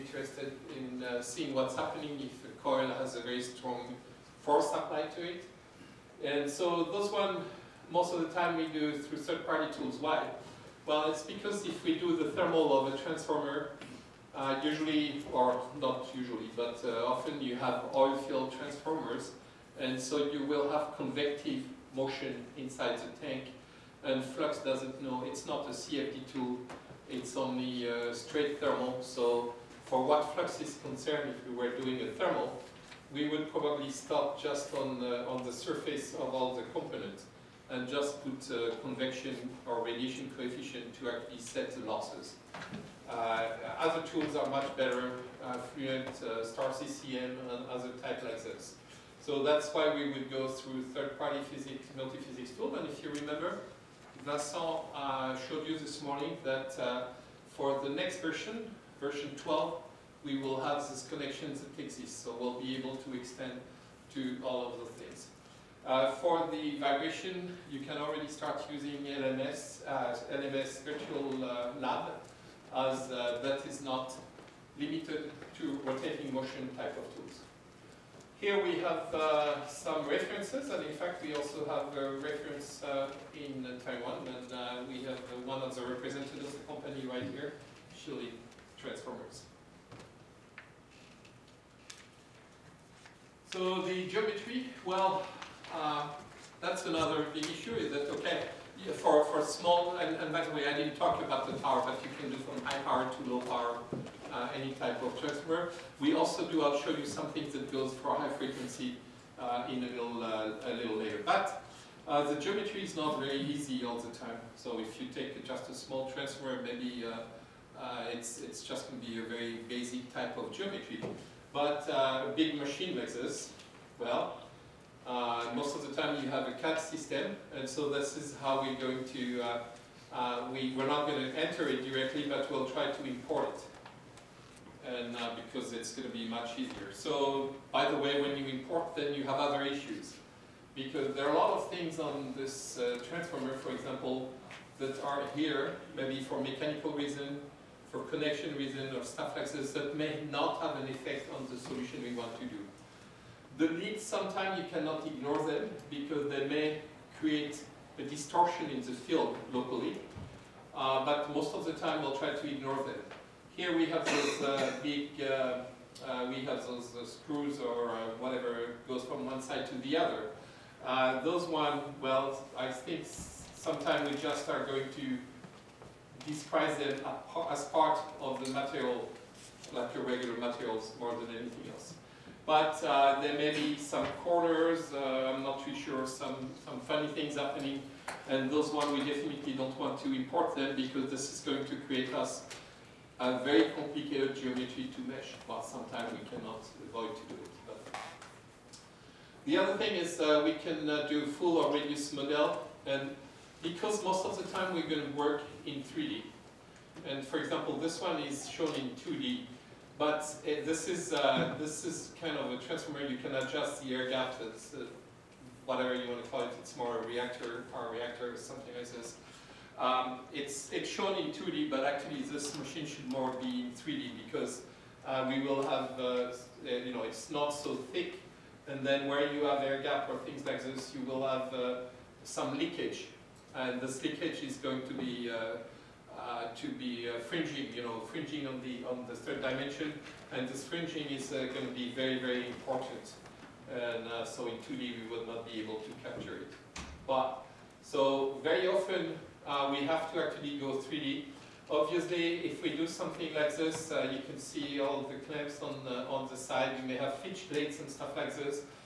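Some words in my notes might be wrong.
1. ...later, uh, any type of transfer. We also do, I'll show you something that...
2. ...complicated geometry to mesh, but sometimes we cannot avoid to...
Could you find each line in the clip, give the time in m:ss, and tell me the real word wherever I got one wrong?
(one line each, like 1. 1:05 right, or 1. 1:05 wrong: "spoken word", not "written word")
1. 1:43 wrong: "power", not "later"
2. 3:13 right.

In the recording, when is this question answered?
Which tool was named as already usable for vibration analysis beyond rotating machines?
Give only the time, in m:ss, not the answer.
1:10.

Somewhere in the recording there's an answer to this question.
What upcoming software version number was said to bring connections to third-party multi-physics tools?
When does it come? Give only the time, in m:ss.
0:58.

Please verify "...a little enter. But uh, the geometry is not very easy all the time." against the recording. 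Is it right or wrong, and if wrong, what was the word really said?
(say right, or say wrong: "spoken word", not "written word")
wrong: "later", not "enter".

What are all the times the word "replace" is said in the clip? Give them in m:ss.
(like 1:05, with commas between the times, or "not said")
not said.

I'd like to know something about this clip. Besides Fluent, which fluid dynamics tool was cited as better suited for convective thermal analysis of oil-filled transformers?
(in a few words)
Star CCM.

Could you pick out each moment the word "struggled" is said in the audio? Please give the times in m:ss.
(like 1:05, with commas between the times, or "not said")
not said.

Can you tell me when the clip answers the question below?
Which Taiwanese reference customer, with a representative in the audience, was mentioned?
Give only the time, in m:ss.
1:27.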